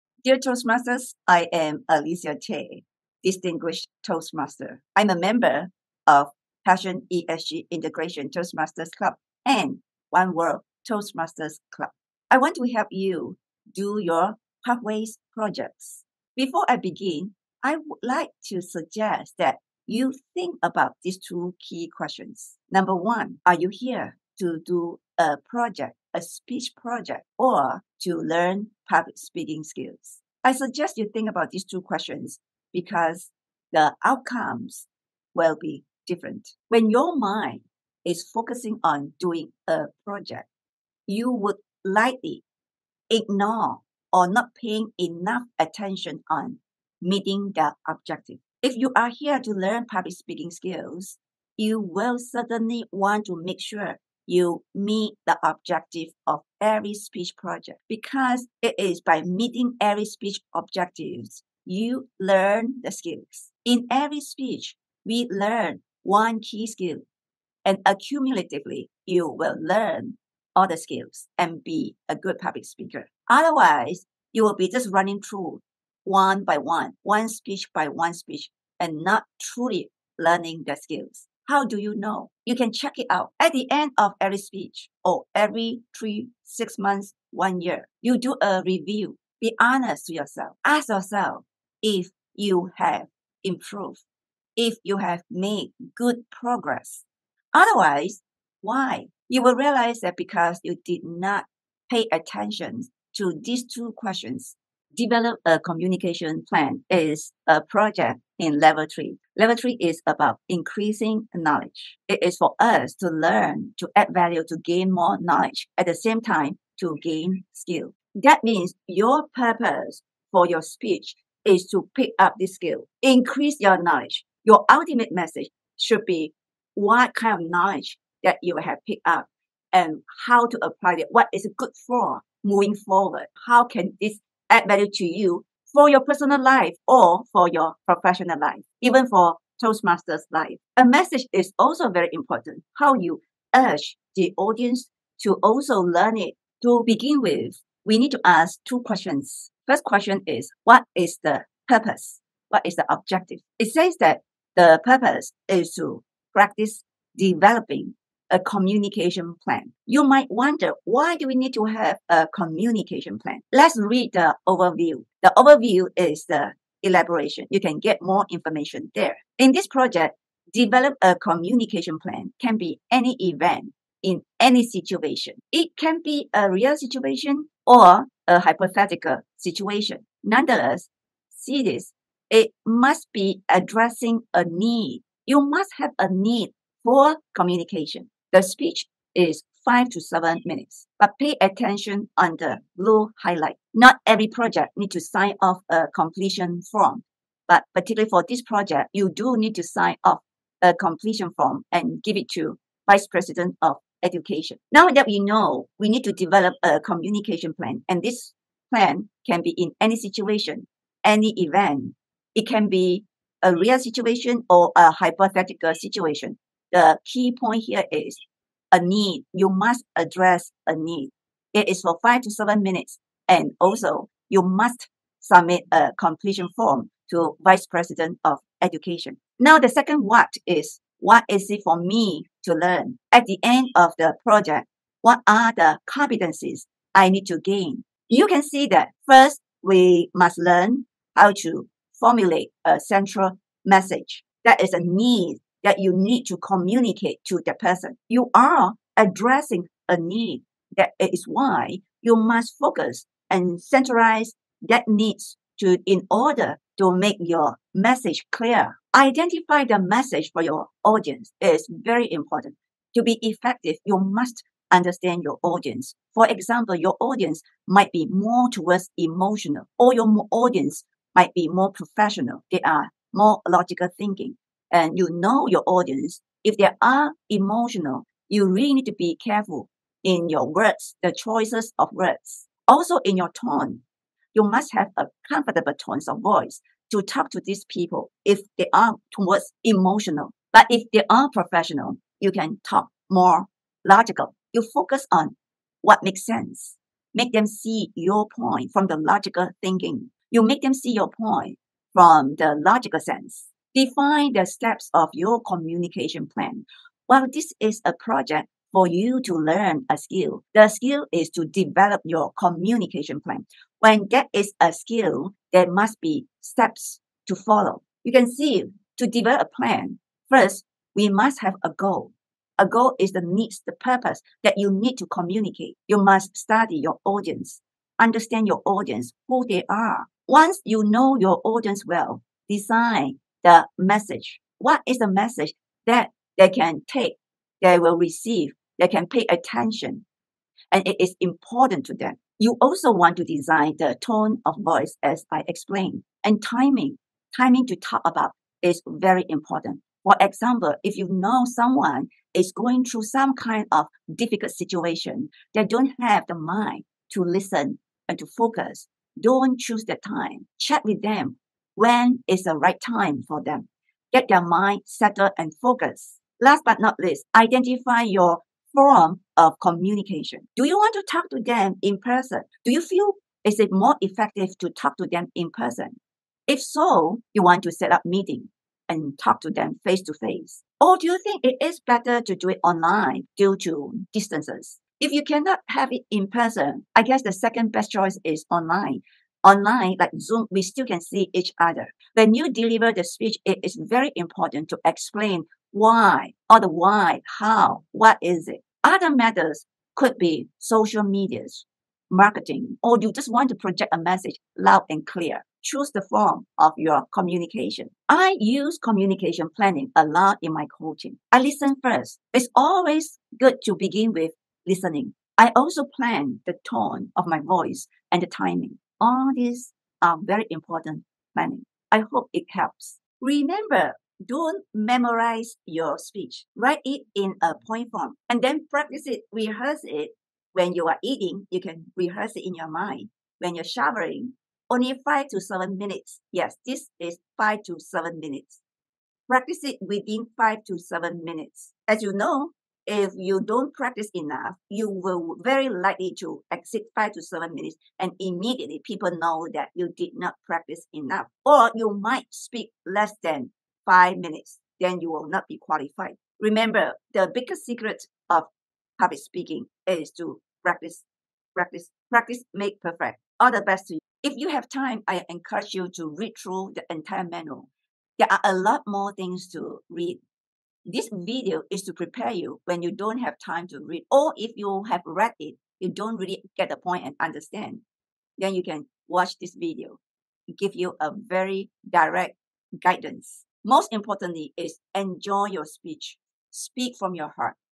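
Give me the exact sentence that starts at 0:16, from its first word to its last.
Before I begin, I would like to suggest that you think about these two key questions.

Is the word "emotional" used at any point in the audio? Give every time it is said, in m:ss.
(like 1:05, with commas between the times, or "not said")
4:28, 4:37, 4:49.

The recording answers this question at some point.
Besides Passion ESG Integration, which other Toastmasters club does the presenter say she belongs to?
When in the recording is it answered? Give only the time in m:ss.
0:10.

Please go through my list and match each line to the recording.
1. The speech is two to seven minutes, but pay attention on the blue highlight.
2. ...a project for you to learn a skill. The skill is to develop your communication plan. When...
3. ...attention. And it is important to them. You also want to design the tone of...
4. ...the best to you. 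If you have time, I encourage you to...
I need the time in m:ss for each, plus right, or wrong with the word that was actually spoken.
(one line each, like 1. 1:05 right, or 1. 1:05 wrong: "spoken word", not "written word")
1. 3:08 wrong: "five", not "two"
2. 5:07 right
3. 5:39 right
4. 7:43 right.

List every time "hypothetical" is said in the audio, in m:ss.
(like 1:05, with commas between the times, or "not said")
2:58, 3:34.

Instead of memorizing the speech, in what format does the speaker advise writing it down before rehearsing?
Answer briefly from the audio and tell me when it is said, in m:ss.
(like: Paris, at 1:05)
Point form, at 7:07.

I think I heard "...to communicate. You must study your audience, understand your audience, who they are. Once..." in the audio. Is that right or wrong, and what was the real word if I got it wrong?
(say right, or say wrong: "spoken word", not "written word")
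right.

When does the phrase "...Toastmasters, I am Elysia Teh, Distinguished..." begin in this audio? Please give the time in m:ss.
0:00.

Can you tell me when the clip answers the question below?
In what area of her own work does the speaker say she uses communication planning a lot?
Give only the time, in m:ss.
6:50.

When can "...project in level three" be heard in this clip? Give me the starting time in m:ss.
1:47.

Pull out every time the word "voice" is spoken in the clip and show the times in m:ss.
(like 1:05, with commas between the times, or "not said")
4:46, 5:44, 6:57.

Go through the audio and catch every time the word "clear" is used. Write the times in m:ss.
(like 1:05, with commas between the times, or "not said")
4:18, 6:45.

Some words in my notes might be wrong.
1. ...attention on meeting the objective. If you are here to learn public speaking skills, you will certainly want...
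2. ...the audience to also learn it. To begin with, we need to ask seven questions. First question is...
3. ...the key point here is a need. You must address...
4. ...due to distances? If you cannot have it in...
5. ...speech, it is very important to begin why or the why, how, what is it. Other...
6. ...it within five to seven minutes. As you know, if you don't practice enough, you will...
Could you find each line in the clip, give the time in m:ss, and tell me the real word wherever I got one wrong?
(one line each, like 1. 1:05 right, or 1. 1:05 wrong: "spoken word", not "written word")
1. 0:45 right
2. 2:24 wrong: "two", not "seven"
3. 3:36 right
4. 6:23 right
5. 6:33 wrong: "explain", not "begin"
6. 7:19 right.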